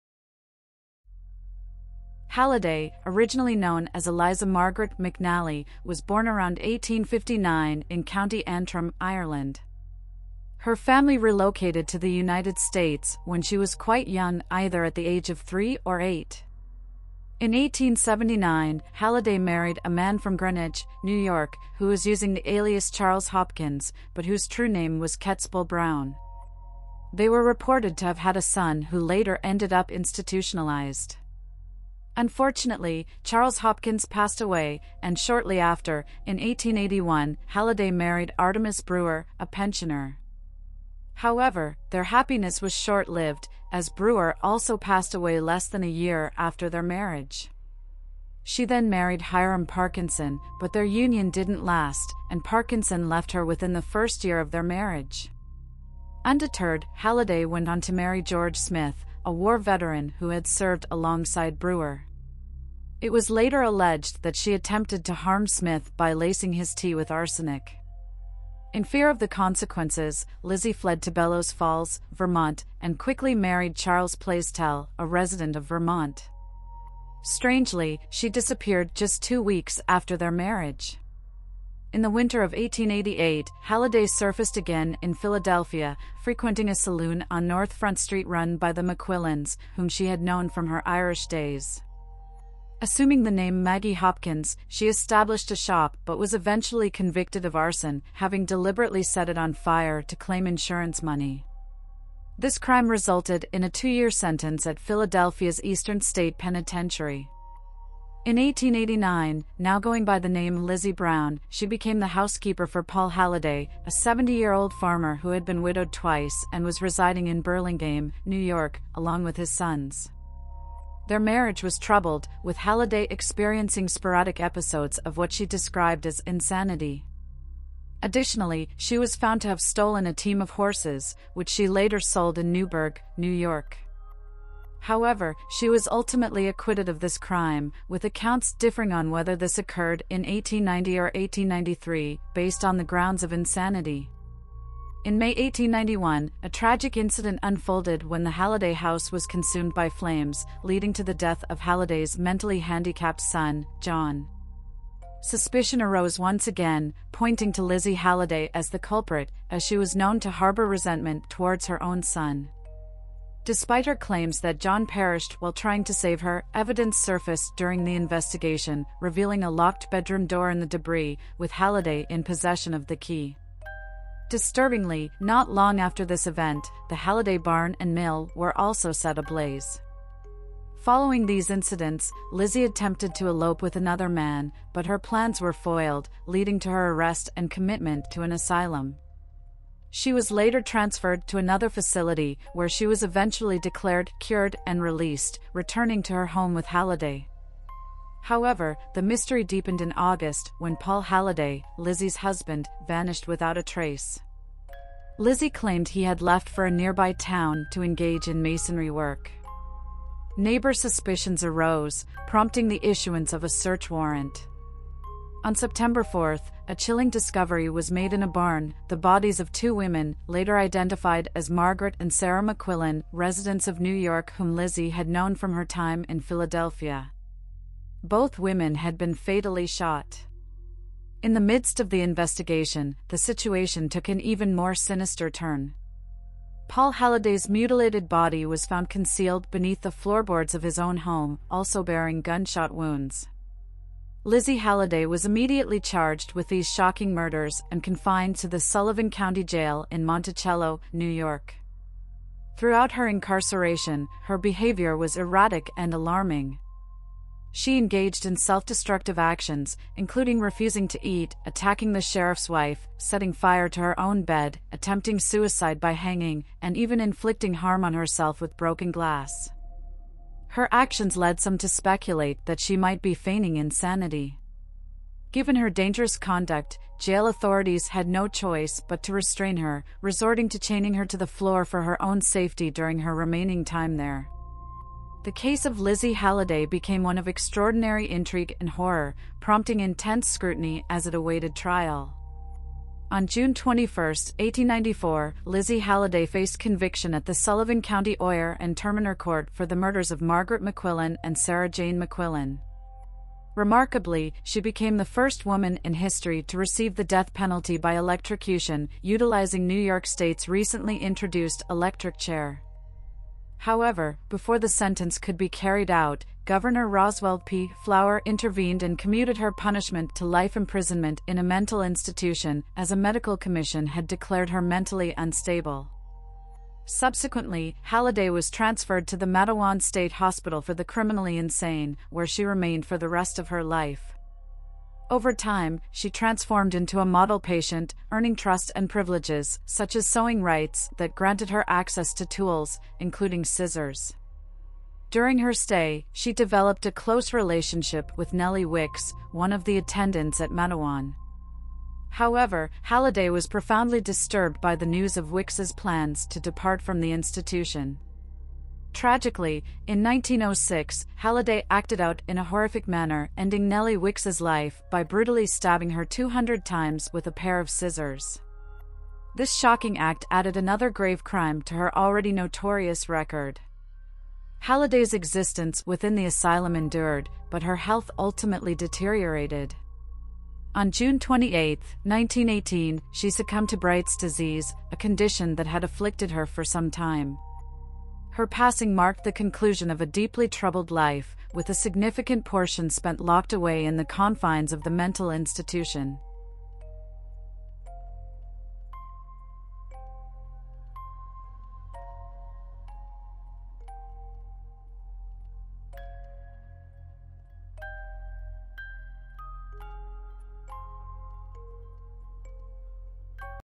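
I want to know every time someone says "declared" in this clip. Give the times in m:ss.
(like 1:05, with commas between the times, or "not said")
3:13, 5:24.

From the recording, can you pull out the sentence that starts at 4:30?
Her actions led some to speculate that she might be feigning insanity.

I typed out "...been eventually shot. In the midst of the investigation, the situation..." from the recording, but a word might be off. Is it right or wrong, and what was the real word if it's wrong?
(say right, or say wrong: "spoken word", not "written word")
wrong: "fatally", not "eventually".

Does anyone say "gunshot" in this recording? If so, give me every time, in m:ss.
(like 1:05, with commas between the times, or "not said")
4:02.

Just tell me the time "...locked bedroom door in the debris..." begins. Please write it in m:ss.
2:49.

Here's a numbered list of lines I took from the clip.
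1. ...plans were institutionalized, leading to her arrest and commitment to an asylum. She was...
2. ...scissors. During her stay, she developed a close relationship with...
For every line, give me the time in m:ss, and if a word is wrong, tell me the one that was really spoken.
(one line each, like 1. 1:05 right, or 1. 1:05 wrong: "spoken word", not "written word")
1. 3:04 wrong: "foiled", not "institutionalized"
2. 5:43 right.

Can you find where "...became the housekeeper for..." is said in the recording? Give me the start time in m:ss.
1:51.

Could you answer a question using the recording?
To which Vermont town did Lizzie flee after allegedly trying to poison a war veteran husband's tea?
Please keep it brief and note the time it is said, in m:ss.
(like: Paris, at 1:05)
Bellows Falls, at 1:11.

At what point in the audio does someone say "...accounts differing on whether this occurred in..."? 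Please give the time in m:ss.
2:18.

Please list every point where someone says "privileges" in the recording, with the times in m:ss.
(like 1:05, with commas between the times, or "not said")
5:38.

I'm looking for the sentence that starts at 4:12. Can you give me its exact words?
Throughout her incarceration, her behavior was erratic and alarming.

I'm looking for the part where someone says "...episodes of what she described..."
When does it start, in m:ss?
2:04.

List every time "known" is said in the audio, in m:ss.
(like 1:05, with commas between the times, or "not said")
0:03, 1:30, 2:39, 3:45.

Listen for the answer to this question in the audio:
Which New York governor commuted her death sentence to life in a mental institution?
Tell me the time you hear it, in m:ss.
5:16.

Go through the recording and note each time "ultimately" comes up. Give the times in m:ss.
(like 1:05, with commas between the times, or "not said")
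2:15, 6:18.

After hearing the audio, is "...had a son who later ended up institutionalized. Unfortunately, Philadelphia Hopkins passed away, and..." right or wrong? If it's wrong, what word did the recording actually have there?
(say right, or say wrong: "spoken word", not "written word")
wrong: "Charles", not "Philadelphia".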